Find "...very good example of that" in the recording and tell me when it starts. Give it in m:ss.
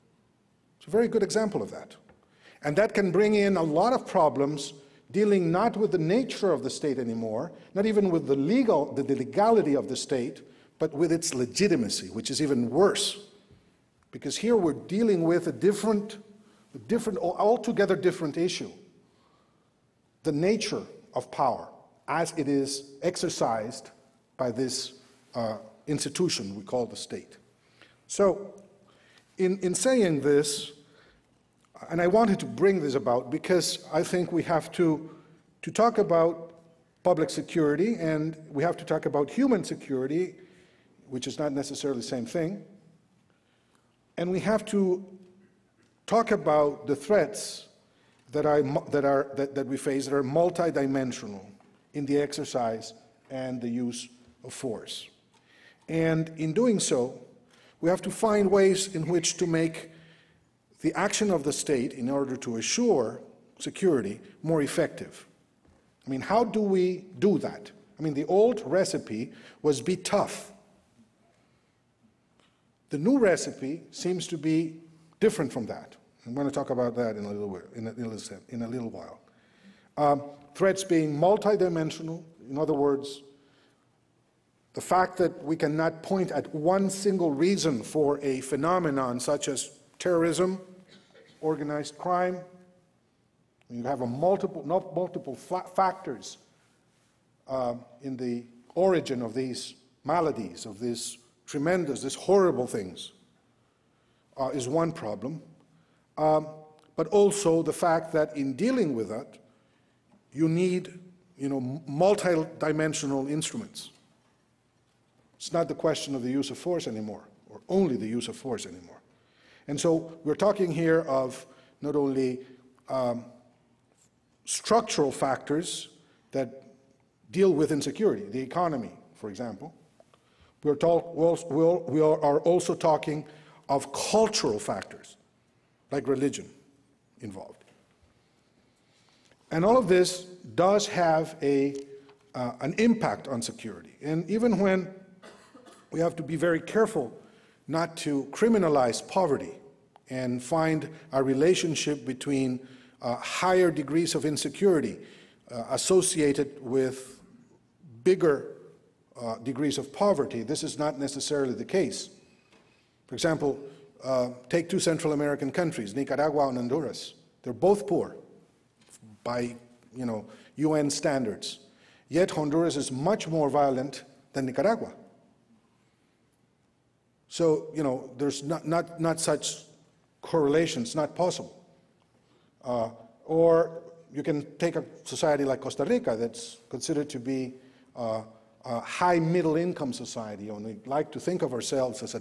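0:00.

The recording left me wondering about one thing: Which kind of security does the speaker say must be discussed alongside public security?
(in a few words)
human security.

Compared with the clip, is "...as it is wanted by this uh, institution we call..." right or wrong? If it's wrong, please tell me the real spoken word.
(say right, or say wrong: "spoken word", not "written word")
wrong: "exercised", not "wanted".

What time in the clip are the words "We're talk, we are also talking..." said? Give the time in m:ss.
2:10.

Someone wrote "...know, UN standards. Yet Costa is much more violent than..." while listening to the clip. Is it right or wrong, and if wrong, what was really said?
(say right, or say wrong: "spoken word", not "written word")
wrong: "Honduras", not "Costa".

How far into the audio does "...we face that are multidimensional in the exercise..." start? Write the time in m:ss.
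0:49.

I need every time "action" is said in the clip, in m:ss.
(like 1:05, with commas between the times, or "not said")
1:00.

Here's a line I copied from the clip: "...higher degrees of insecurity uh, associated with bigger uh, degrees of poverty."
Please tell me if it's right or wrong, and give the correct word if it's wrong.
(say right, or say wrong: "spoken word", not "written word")
right.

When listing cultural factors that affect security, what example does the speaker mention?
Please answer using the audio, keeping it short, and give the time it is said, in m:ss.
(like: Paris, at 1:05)
religion, at 2:16.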